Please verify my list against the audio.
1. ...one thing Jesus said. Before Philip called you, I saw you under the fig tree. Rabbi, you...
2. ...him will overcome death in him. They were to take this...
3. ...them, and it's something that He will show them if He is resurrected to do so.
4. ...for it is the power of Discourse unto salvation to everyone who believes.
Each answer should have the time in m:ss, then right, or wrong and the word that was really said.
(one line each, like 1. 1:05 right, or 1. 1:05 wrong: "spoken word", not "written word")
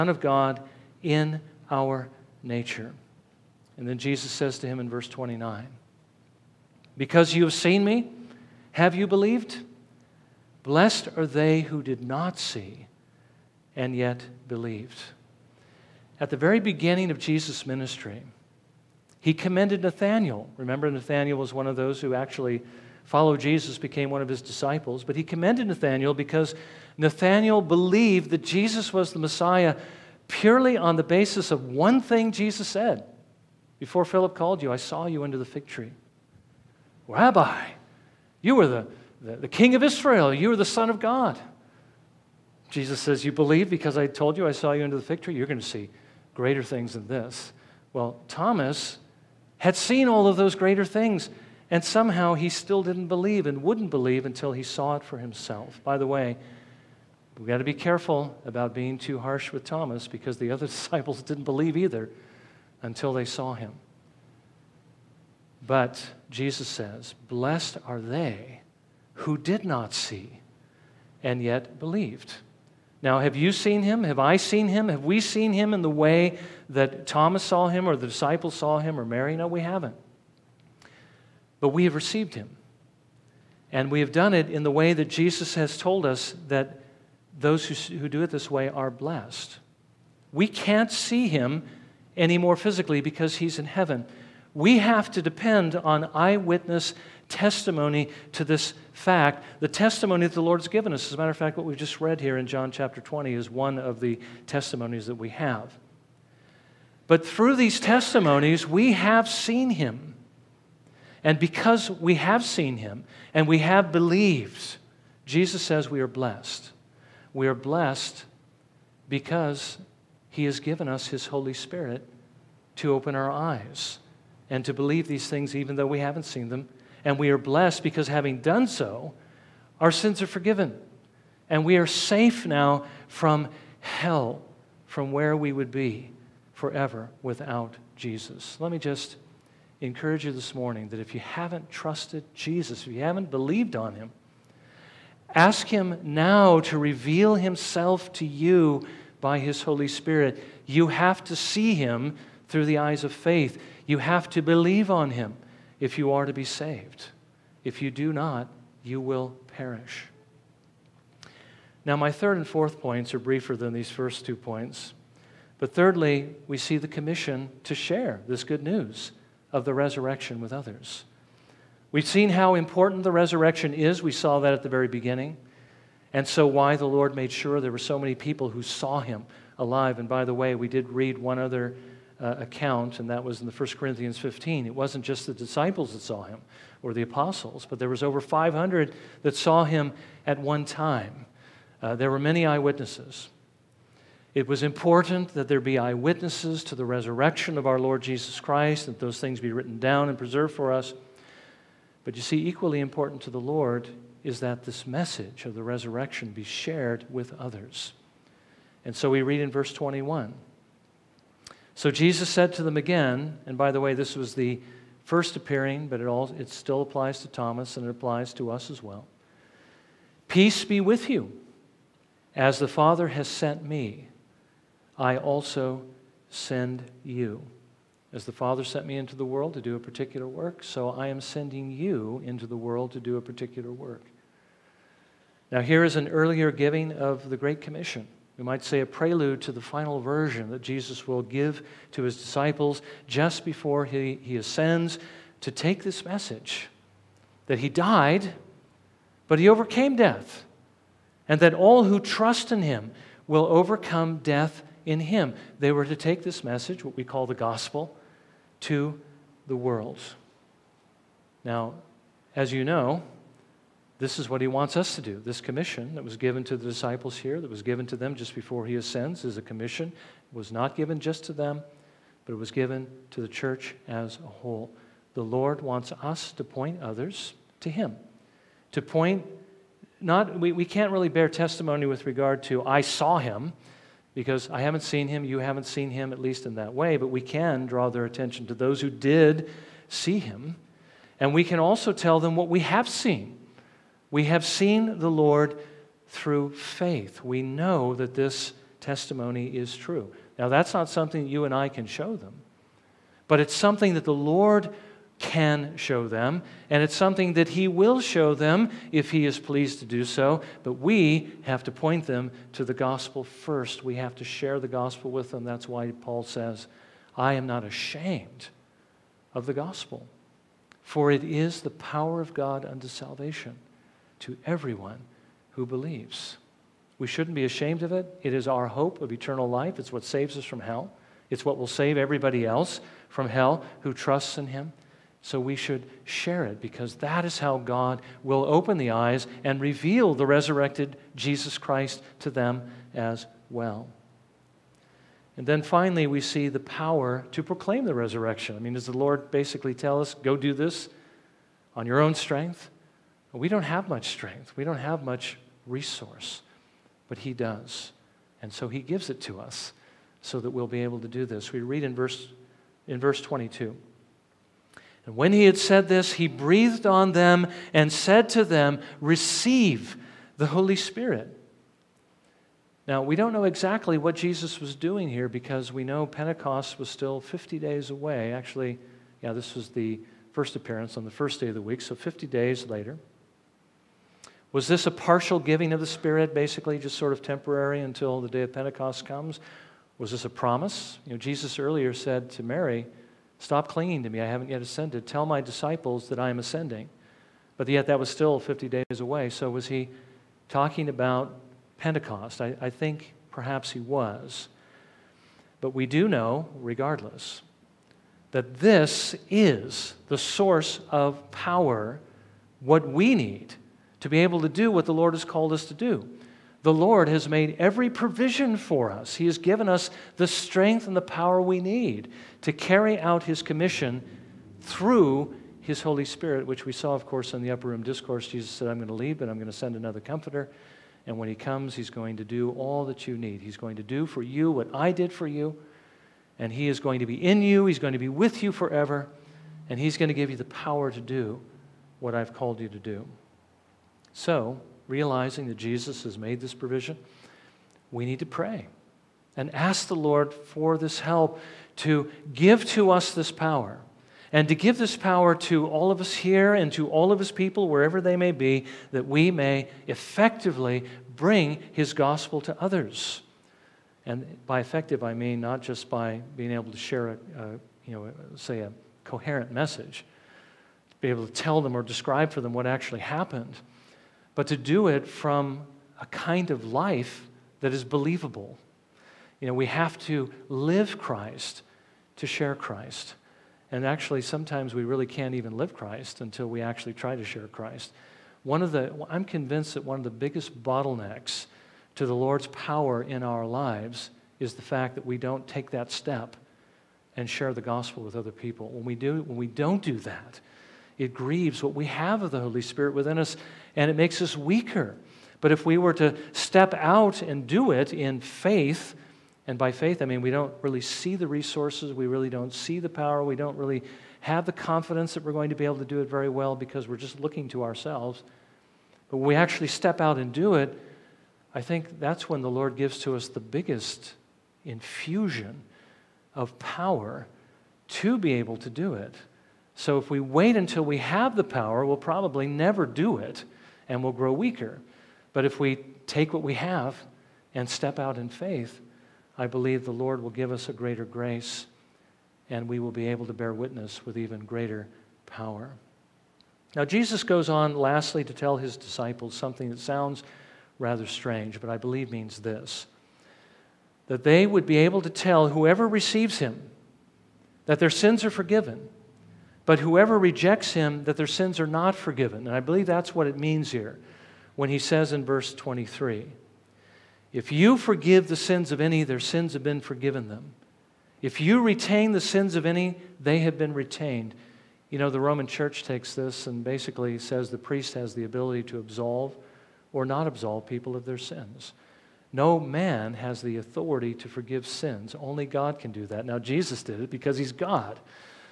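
1. 0:31 right
2. 4:12 right
3. 5:06 wrong: "pleased", not "resurrected"
4. 5:20 wrong: "God", not "Discourse".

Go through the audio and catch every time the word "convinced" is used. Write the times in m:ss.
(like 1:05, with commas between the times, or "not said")
8:09.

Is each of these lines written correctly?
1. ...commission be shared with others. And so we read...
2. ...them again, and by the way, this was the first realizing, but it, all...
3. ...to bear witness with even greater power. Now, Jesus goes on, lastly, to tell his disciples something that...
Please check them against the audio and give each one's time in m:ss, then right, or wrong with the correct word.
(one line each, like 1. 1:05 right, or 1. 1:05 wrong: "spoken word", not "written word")
1. 3:25 wrong: "resurrection", not "commission"
2. 3:32 wrong: "appearing", not "realizing"
3. 9:03 right.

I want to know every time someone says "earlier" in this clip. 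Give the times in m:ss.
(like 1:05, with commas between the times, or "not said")
3:56, 6:31.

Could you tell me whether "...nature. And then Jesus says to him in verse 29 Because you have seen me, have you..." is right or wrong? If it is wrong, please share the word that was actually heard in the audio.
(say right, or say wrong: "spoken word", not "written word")
right.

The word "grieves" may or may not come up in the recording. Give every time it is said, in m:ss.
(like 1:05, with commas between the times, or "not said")
8:21.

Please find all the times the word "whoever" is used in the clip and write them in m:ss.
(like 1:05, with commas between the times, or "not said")
9:15, 9:19.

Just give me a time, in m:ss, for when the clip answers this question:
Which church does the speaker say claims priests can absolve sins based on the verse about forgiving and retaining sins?
9:35.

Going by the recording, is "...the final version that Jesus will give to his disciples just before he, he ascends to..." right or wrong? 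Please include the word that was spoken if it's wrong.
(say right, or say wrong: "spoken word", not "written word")
right.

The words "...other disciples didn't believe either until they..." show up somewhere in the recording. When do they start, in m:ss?
1:00.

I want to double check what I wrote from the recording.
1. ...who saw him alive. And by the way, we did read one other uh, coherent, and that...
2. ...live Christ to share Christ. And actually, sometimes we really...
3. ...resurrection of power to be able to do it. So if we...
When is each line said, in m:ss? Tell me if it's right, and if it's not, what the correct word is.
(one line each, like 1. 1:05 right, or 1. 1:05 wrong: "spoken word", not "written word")
1. 2:58 wrong: "account", not "coherent"
2. 8:00 right
3. 8:44 wrong: "infusion", not "resurrection".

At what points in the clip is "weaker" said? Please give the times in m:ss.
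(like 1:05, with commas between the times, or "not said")
8:24, 8:54.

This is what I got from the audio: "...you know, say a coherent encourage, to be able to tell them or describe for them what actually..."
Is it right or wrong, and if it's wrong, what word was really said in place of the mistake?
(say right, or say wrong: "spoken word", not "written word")
wrong: "message", not "encourage".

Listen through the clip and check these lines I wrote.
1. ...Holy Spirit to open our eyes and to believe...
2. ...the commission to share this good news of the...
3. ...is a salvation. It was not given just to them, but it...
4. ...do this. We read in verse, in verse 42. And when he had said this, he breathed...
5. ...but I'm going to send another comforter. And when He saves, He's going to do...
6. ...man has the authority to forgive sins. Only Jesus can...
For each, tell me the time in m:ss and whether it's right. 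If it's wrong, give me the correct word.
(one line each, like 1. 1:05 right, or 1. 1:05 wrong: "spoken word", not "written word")
1. 2:01 right
2. 2:46 right
3. 4:29 wrong: "commission", not "salvation"
4. 6:01 wrong: "22", not "42"
5. 7:09 wrong: "comes", not "saves"
6. 9:42 wrong: "God", not "Jesus".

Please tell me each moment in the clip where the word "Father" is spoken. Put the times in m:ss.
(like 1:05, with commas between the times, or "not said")
3:42, 3:48.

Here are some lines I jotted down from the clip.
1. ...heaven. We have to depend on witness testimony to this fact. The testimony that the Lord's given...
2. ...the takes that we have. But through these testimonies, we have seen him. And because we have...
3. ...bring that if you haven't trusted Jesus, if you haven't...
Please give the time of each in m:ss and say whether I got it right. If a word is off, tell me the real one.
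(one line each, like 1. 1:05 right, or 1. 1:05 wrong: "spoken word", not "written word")
1. 1:33 wrong: "eyewitness", not "witness"
2. 1:44 wrong: "testimonies", not "takes"
3. 2:20 wrong: "morning", not "bring".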